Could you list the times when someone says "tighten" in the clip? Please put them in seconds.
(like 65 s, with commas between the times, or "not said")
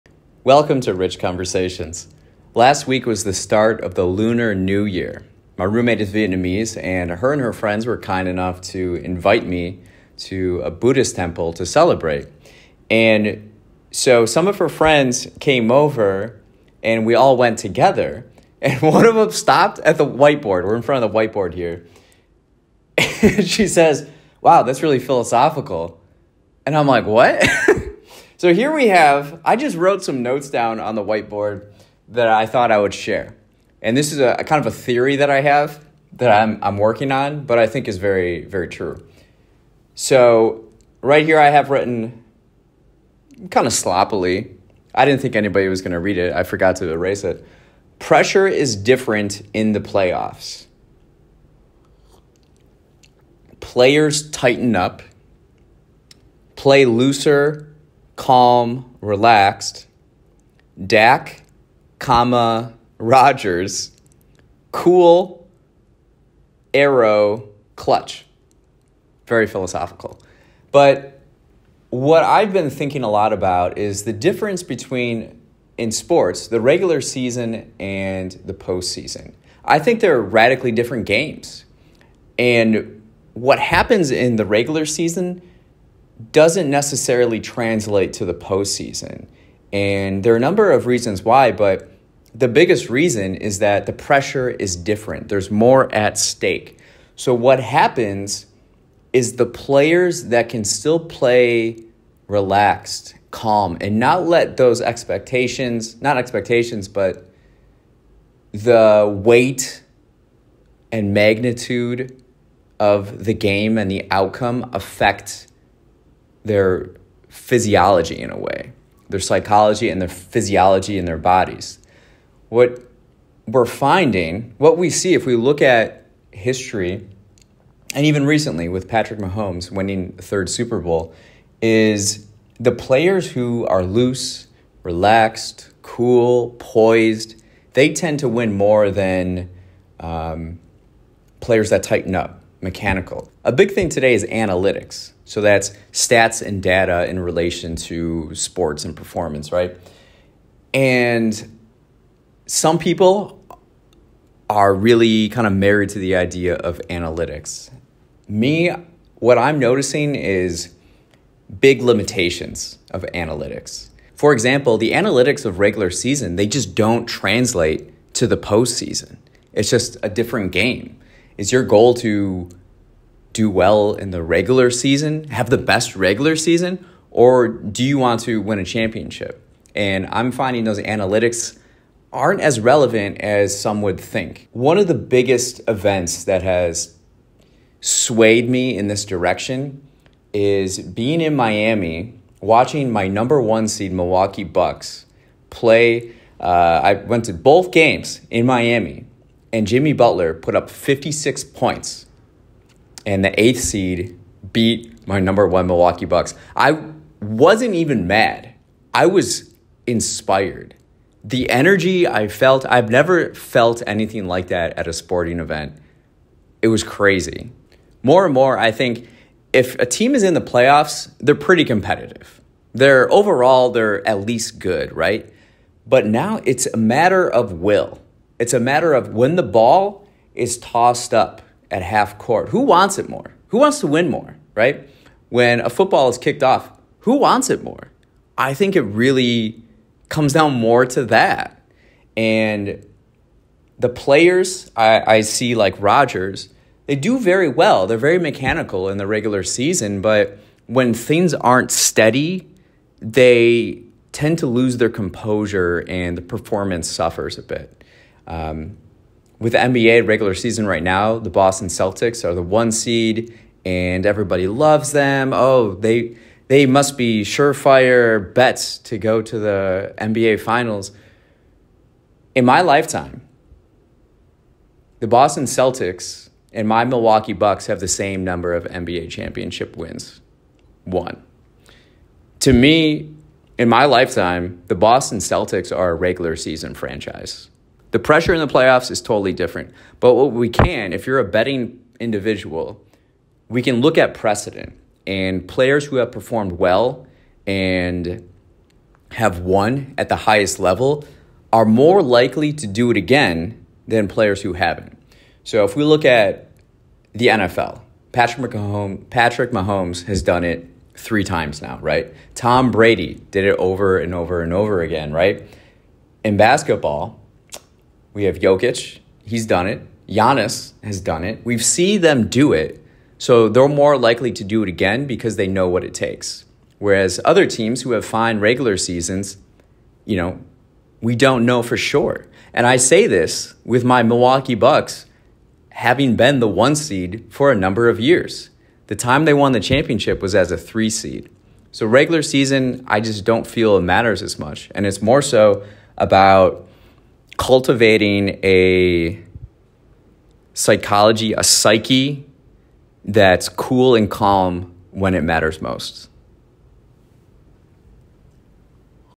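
54 s, 141 s.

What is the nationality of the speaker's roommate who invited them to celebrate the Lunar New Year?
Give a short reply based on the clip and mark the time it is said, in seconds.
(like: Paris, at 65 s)
Vietnamese, at 6 s.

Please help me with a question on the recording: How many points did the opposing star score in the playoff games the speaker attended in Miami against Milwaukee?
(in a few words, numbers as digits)
56.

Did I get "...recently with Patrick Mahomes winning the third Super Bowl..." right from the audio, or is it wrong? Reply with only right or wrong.
right.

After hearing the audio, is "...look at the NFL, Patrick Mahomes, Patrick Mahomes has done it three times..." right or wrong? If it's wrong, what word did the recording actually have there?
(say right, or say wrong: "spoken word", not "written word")
right.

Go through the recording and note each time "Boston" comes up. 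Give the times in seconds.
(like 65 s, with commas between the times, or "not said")
261 s, 275 s, 284 s.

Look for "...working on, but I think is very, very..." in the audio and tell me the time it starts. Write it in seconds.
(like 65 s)
36 s.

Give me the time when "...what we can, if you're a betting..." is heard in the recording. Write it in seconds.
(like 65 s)
290 s.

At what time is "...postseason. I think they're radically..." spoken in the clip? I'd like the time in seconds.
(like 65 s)
78 s.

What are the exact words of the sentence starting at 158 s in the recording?
Me, what I'm noticing is big limitations of analytics.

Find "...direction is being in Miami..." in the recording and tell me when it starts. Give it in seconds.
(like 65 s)
189 s.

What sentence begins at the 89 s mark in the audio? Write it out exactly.
And there are a number of reasons why, but the biggest reason is that the pressure is different.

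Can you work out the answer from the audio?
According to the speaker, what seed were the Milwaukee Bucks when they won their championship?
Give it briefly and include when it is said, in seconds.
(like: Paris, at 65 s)
3 seed, at 340 s.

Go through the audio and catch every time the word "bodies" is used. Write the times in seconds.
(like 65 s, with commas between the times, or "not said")
121 s.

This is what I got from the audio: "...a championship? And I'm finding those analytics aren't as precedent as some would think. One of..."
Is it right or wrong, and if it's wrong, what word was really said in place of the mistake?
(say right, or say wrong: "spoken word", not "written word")
wrong: "relevant", not "precedent".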